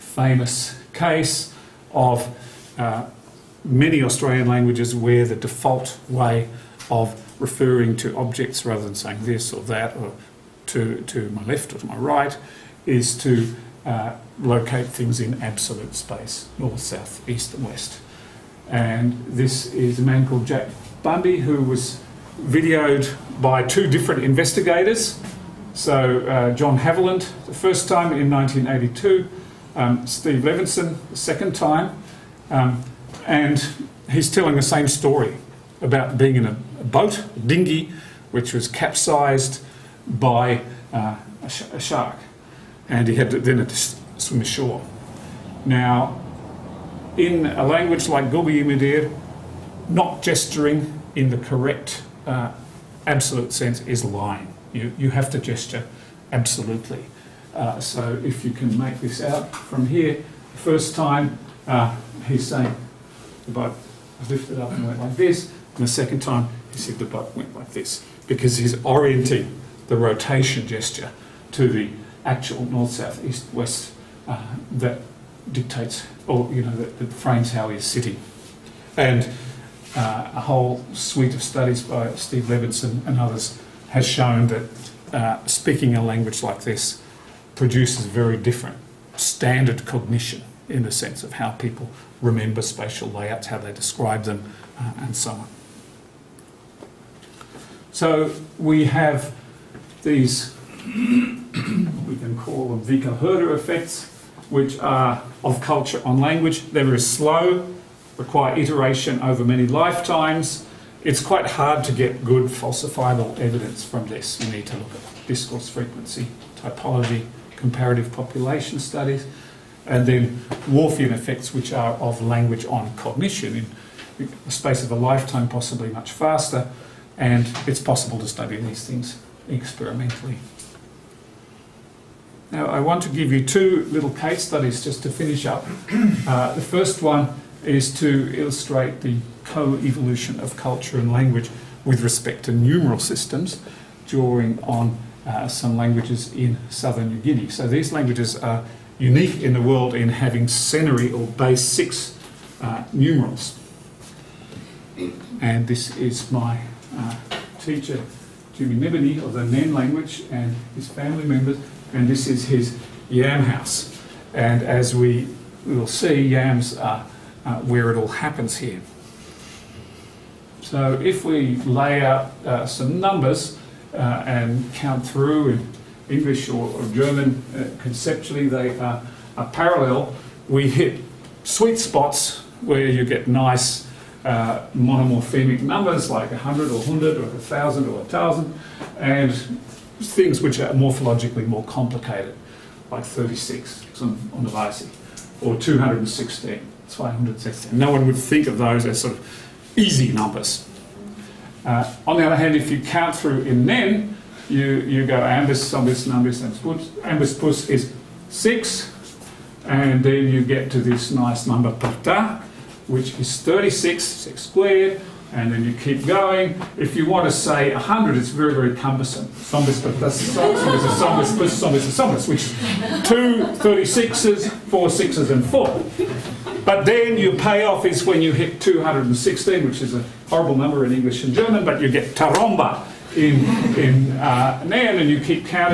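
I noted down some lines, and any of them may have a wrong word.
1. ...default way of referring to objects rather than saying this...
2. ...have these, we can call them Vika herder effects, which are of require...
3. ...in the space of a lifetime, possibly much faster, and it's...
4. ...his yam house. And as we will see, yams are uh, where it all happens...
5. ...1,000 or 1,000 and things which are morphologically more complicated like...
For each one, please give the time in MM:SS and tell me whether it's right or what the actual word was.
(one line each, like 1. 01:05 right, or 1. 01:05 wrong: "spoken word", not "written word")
1. 00:05 right
2. 01:38 wrong: "culture", not "require"
3. 02:04 right
4. 02:42 right
5. 03:07 right.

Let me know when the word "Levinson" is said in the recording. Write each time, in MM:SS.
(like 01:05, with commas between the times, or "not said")
00:30, 01:22.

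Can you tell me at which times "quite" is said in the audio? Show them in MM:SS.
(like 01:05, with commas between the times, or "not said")
01:51.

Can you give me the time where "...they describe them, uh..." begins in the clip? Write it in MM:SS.
01:33.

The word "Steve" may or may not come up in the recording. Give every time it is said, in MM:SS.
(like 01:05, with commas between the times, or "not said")
00:30, 01:22.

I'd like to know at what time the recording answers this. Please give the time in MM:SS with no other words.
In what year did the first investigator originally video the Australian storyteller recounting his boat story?
00:28.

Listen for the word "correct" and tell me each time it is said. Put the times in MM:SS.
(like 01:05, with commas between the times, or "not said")
00:51.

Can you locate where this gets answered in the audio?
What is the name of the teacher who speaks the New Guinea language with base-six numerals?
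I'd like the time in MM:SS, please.
02:38.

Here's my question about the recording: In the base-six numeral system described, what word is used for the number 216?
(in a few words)
taromba.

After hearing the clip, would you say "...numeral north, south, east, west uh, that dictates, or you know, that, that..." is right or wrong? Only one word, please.
wrong.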